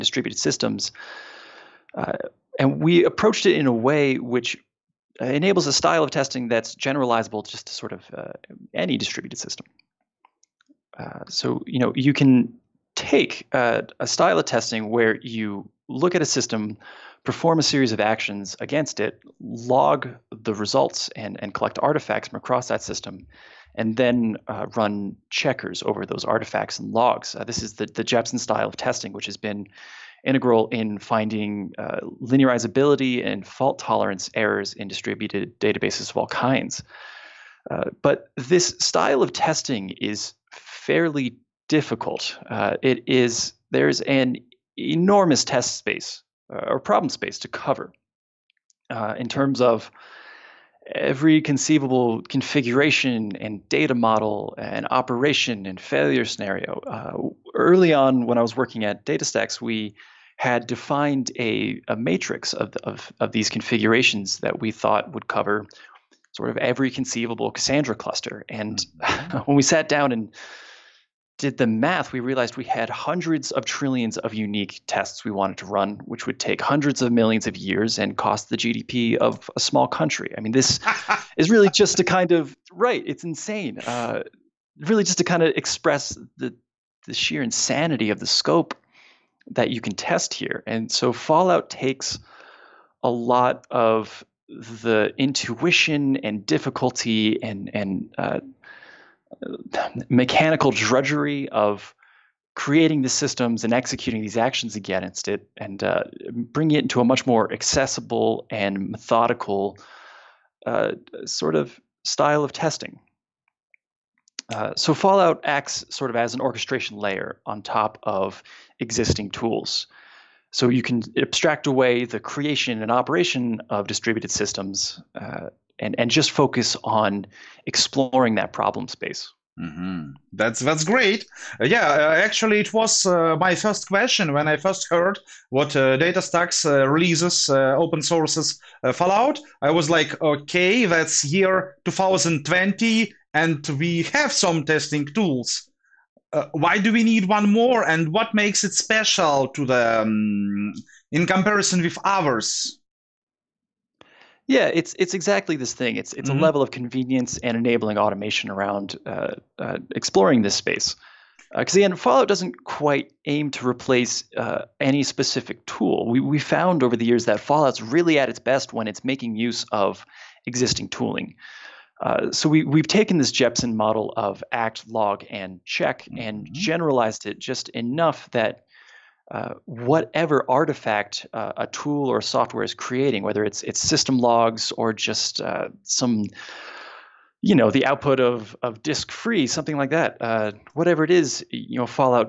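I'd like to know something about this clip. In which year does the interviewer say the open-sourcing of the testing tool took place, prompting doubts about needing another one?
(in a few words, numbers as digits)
2020.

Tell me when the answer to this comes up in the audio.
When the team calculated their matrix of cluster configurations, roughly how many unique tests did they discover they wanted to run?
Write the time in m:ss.
1:12.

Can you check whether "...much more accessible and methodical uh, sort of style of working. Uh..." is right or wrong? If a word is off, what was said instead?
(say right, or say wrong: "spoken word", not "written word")
wrong: "testing", not "working".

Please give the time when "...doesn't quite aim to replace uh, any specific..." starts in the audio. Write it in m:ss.
2:42.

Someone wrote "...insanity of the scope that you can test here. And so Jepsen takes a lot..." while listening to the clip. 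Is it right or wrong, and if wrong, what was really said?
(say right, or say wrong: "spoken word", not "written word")
wrong: "Fallout", not "Jepsen".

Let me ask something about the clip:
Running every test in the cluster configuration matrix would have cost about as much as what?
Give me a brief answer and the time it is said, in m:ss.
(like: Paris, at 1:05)
the GDP of a small country, at 1:18.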